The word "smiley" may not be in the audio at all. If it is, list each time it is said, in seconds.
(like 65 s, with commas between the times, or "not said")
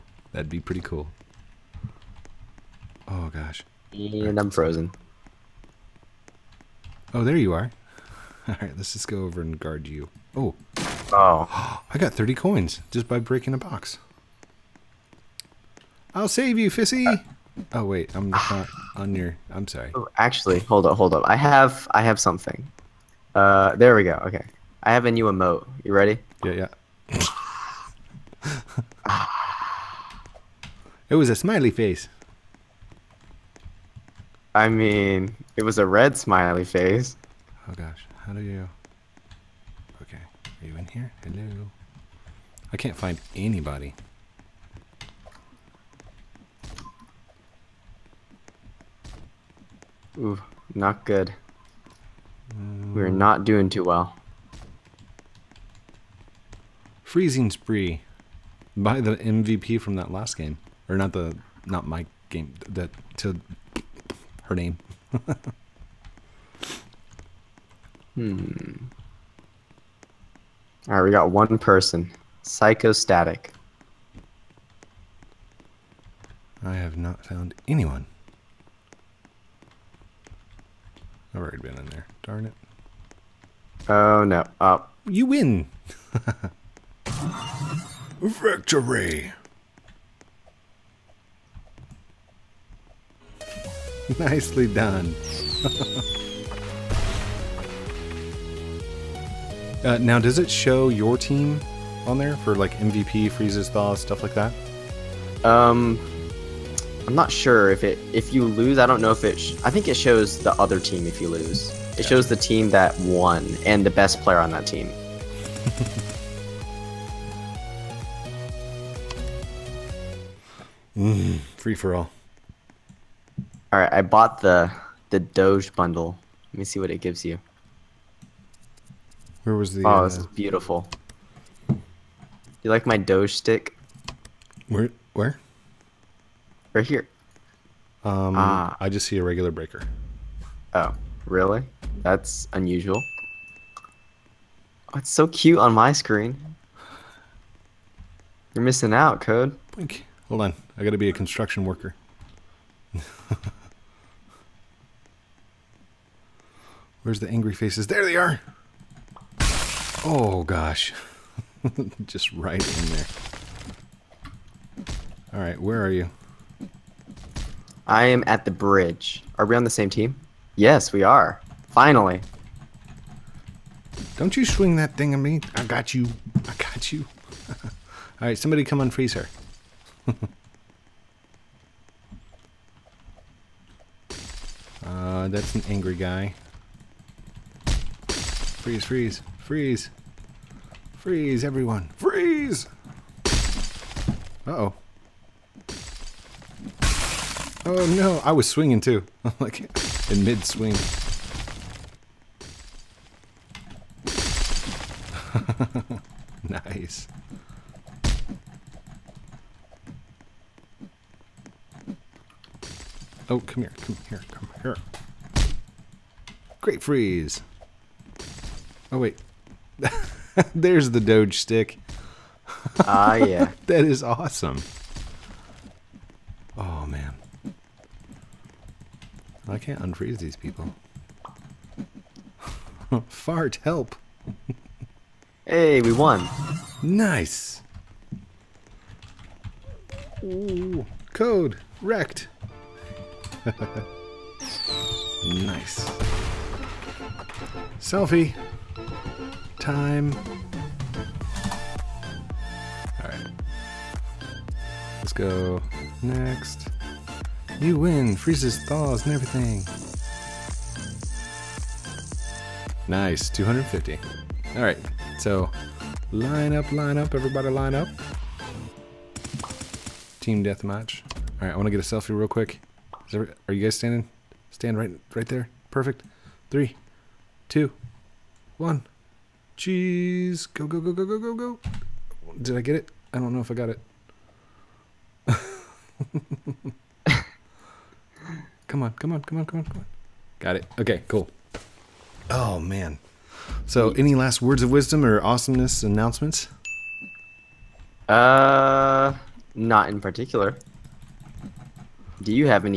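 31 s, 36 s.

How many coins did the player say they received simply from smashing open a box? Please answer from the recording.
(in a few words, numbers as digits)
30.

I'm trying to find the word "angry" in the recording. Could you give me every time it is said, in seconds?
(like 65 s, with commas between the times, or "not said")
157 s, 185 s.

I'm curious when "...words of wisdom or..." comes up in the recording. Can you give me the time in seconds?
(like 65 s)
294 s.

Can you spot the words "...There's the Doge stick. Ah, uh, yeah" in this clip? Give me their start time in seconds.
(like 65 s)
220 s.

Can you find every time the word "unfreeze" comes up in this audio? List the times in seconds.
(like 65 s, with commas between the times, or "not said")
178 s, 229 s.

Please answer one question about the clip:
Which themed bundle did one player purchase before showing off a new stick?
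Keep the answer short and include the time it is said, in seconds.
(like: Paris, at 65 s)
Doge bundle, at 125 s.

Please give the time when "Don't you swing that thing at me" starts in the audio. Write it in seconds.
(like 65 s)
174 s.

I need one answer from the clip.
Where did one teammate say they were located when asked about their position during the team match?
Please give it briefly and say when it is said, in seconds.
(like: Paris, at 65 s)
the bridge, at 168 s.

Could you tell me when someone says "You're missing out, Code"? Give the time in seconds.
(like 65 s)
148 s.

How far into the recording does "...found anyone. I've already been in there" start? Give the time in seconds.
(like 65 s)
77 s.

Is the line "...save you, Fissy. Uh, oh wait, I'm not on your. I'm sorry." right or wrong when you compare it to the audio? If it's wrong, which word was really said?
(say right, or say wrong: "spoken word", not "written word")
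right.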